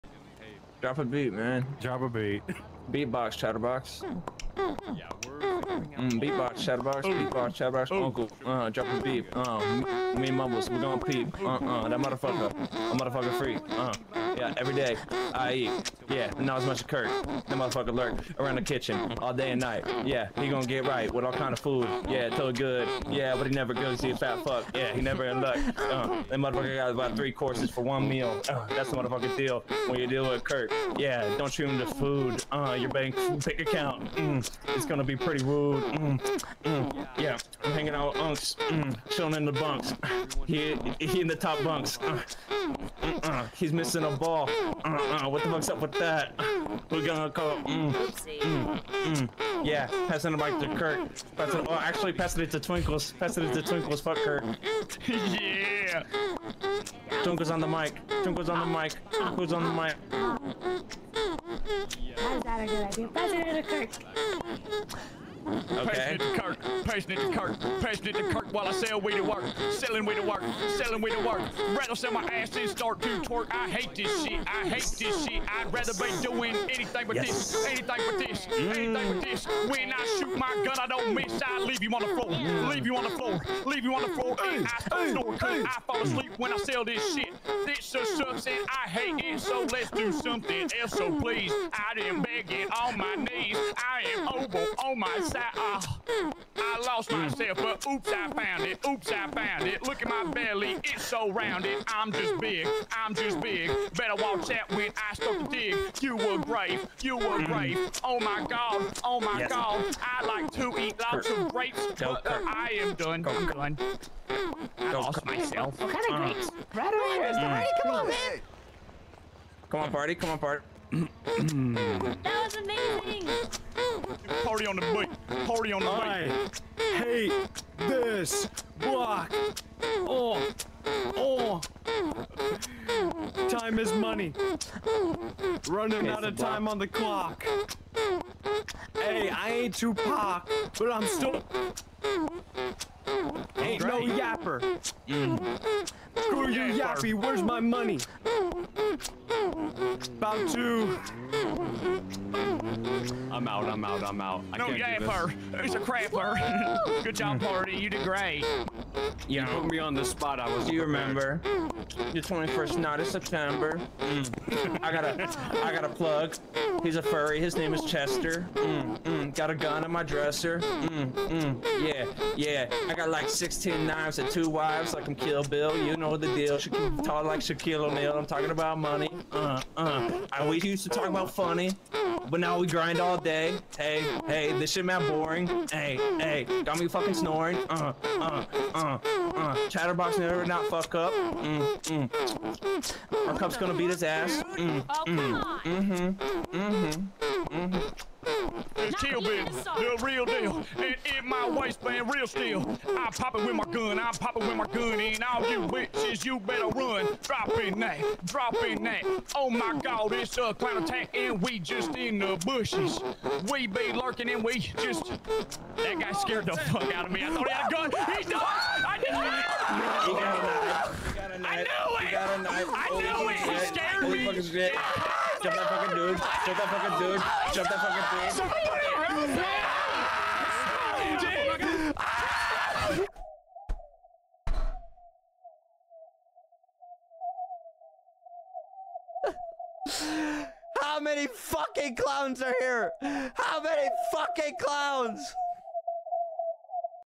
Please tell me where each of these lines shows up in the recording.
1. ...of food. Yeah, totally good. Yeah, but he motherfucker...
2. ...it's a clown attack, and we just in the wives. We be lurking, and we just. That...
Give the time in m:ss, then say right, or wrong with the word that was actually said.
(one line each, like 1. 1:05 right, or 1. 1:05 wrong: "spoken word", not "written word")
1. 0:21 wrong: "never", not "motherfucker"
2. 3:30 wrong: "bushes", not "wives".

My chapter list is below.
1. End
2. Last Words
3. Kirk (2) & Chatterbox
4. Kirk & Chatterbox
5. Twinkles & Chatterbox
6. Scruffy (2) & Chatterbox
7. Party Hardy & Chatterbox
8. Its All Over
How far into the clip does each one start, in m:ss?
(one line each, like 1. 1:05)
1. 3:35
2. 4:00
3. 3:19
4. 1:02
5. 0:52
6. 2:35
7. 2:00
8. 3:50.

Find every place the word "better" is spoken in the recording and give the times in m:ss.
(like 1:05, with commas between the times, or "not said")
1:43, 3:26.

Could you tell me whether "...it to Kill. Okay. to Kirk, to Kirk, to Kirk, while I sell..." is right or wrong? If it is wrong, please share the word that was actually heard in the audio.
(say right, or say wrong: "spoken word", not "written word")
wrong: "Kirk", not "Kill".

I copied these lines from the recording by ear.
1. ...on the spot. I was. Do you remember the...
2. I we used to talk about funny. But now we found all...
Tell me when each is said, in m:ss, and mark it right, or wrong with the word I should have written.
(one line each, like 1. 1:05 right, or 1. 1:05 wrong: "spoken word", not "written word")
1. 2:39 right
2. 3:00 wrong: "grind", not "found".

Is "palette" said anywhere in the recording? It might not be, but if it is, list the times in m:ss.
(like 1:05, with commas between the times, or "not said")
not said.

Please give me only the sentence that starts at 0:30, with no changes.
Yeah, don't treat him to food.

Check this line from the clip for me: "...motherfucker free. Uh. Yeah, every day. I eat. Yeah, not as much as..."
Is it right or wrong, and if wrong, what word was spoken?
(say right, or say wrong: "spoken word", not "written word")
right.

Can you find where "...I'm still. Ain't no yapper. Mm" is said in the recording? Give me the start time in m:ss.
2:20.